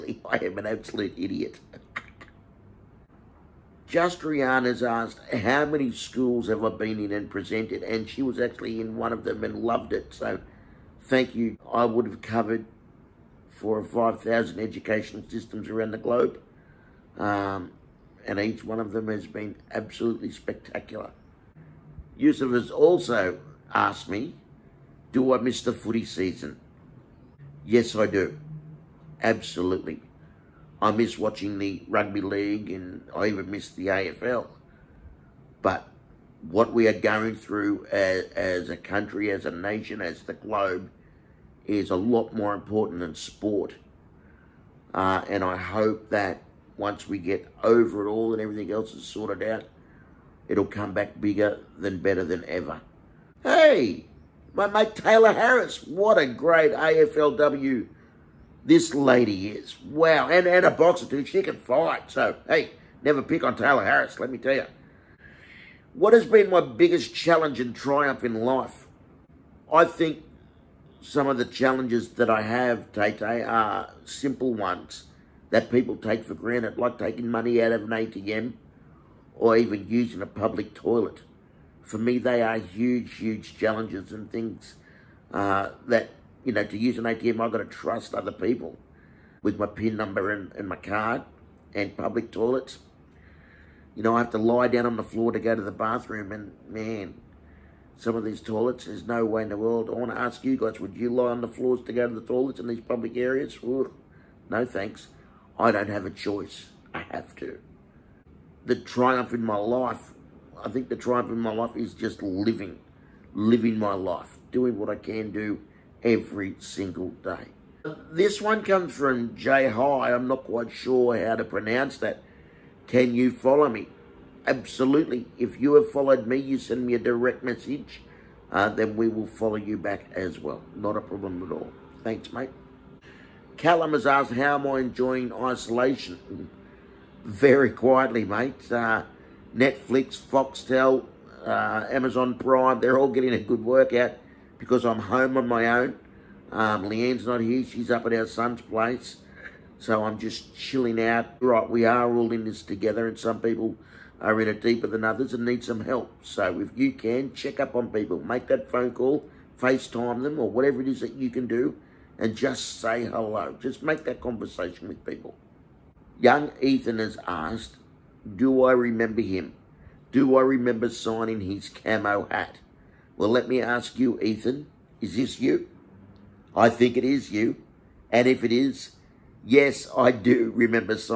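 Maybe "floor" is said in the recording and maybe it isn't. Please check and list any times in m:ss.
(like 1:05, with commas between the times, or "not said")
1:35, 1:41.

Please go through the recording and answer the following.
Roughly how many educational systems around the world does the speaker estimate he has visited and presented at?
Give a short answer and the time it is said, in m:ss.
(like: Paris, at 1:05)
4,000 or 5,000, at 0:13.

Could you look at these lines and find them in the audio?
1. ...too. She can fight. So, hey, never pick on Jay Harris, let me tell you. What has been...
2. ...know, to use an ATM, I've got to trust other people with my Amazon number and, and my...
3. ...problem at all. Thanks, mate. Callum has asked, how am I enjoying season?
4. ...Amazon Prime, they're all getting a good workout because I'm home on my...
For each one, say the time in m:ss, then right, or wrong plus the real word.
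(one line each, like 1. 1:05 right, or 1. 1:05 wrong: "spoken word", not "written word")
1. 1:01 wrong: "Tayla", not "Jay"
2. 1:26 wrong: "PIN", not "Amazon"
3. 2:10 wrong: "isolation", not "season"
4. 2:21 right.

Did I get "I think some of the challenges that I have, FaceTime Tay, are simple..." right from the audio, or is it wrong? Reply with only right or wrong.
wrong.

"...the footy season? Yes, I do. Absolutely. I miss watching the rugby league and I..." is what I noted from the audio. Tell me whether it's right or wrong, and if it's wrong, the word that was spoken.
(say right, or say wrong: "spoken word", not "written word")
right.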